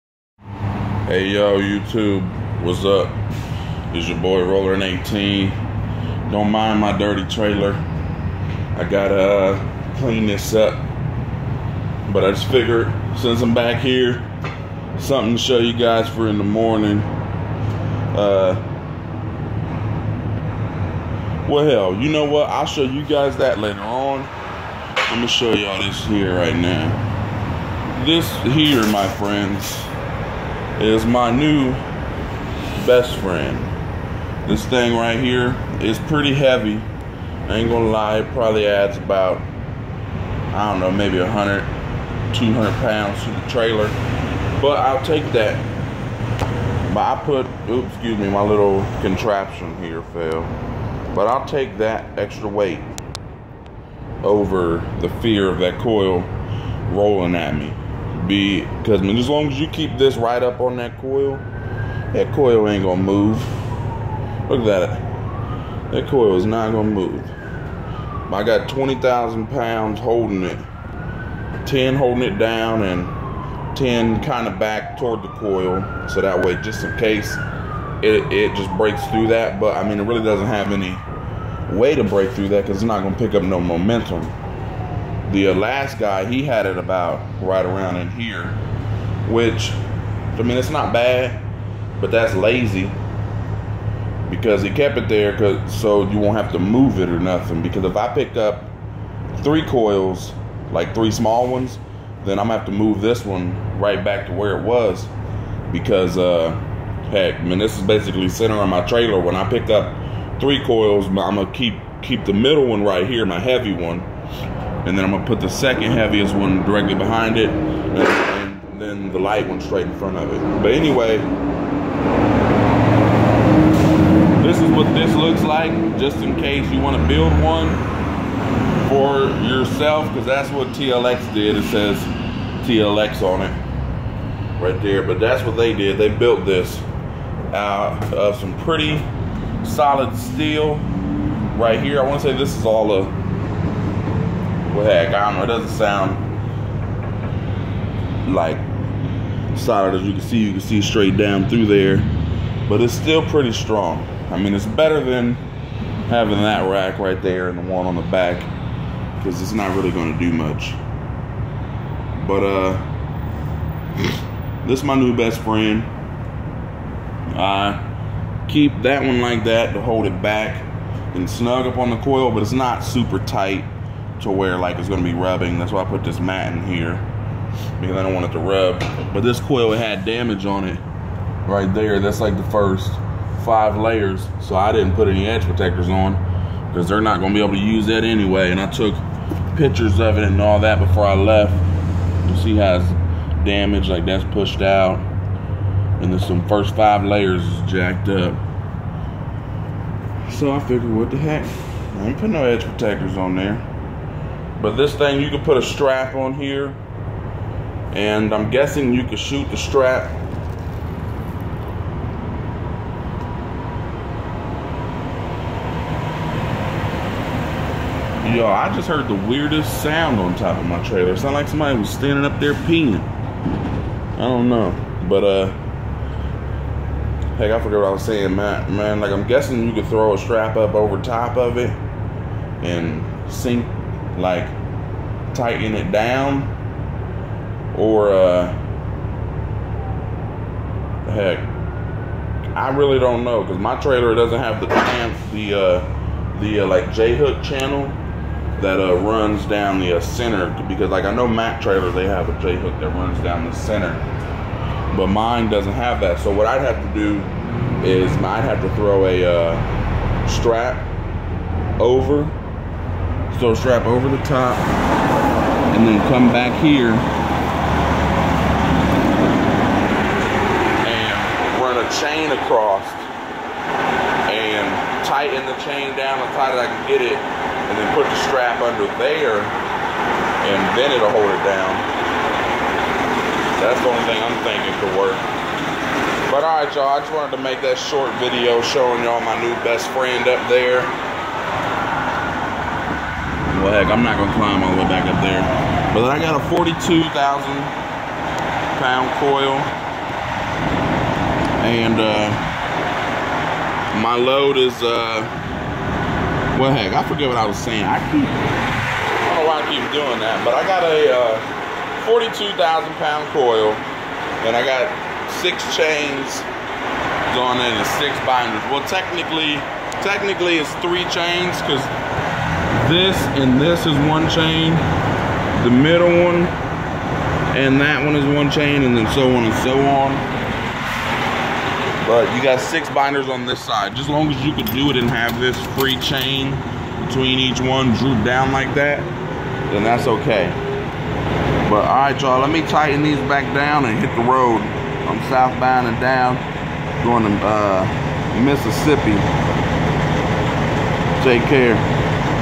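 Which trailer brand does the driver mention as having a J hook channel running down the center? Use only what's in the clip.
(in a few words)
Mac.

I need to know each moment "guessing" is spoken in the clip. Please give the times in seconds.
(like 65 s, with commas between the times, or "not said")
208 s, 229 s.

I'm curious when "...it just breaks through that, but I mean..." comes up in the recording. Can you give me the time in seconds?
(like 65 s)
78 s.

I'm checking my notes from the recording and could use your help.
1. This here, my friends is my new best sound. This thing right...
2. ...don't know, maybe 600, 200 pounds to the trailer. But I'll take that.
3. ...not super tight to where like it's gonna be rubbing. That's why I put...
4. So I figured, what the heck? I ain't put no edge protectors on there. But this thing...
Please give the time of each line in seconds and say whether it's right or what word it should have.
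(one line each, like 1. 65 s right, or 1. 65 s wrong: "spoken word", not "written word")
1. 28 s wrong: "friend", not "sound"
2. 40 s wrong: "100", not "600"
3. 172 s right
4. 200 s right.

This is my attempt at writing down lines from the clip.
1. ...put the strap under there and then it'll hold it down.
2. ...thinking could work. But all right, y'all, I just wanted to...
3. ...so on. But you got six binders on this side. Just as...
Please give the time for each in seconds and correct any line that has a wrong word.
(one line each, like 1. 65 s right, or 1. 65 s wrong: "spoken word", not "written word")
1. 277 s right
2. 284 s right
3. 329 s right.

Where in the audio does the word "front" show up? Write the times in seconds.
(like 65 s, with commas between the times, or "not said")
119 s.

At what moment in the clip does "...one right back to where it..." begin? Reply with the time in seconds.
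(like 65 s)
103 s.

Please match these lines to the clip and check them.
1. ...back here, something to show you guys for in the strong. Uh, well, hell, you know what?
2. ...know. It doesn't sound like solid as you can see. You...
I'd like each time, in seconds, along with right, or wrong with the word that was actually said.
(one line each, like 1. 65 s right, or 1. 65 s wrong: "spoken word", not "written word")
1. 13 s wrong: "morning", not "strong"
2. 145 s right.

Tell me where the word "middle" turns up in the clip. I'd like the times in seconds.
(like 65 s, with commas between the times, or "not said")
112 s, 325 s.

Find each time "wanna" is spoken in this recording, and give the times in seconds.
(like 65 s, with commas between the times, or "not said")
126 s, 142 s.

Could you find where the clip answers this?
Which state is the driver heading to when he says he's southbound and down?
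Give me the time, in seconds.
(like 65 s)
348 s.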